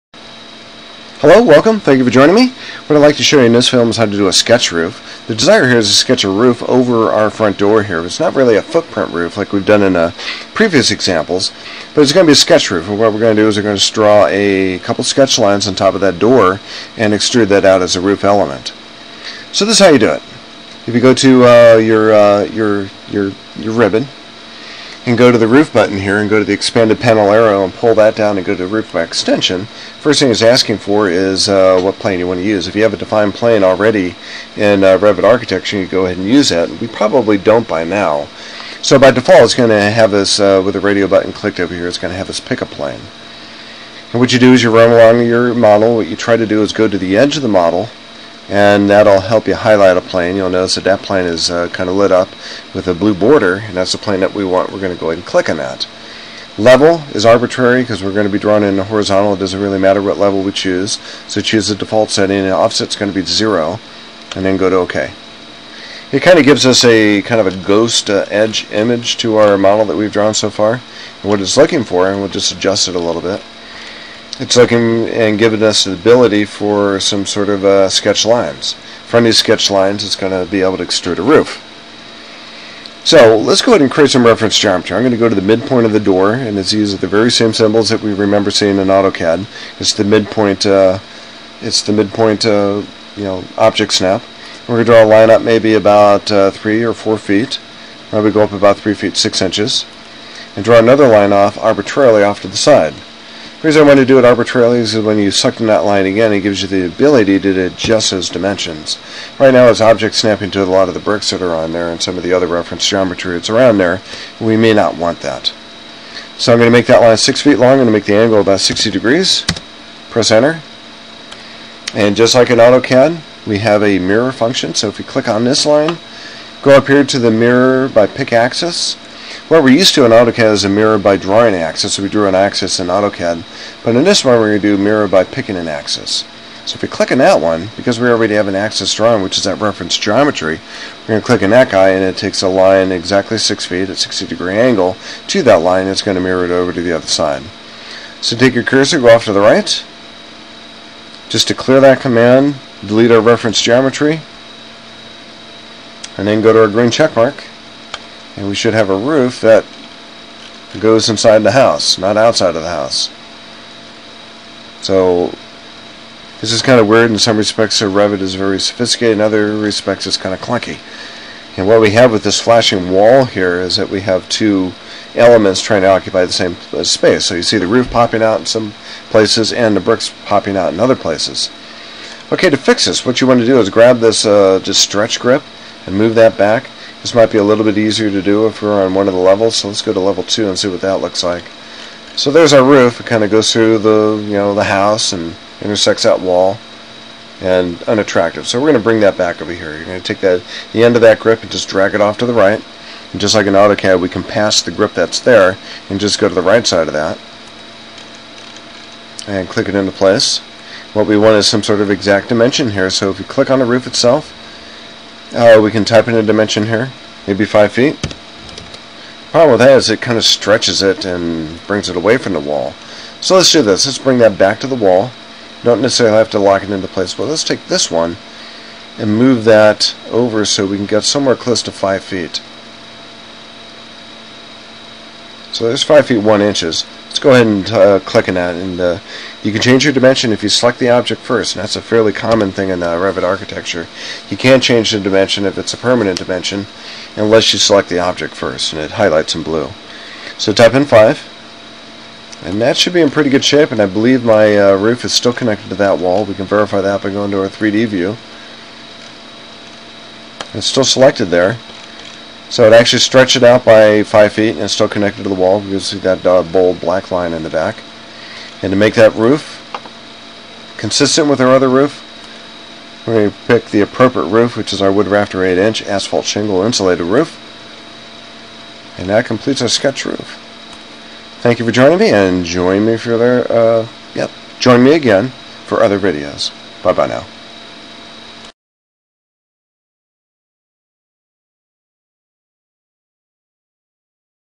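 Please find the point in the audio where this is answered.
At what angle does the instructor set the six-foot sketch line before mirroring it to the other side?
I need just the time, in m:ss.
1:58.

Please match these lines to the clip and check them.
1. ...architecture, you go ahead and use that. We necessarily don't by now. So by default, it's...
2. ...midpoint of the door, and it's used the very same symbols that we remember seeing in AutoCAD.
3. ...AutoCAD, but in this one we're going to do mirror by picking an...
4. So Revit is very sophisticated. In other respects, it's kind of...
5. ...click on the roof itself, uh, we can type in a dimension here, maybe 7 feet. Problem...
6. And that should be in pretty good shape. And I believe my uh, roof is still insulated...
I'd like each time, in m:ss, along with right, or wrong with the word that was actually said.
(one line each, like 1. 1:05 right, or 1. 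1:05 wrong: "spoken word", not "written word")
1. 0:35 wrong: "probably", not "necessarily"
2. 1:25 right
3. 2:12 right
4. 2:47 right
5. 3:33 wrong: "5", not "7"
6. 4:12 wrong: "connected", not "insulated".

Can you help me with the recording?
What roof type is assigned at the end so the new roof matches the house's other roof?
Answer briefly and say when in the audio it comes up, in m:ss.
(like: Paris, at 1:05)
wood rafter 8 inch asphalt shingle insulated, at 4:34.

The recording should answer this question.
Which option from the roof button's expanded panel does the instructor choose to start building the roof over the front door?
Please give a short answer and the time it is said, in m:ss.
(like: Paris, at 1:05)
roof extrusion, at 0:28.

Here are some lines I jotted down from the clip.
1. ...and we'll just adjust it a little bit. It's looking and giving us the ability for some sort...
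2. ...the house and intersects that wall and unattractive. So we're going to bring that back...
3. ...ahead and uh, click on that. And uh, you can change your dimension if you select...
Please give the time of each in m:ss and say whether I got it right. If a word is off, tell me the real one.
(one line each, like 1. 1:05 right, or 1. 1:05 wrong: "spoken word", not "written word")
1. 1:12 right
2. 3:14 right
3. 3:57 right.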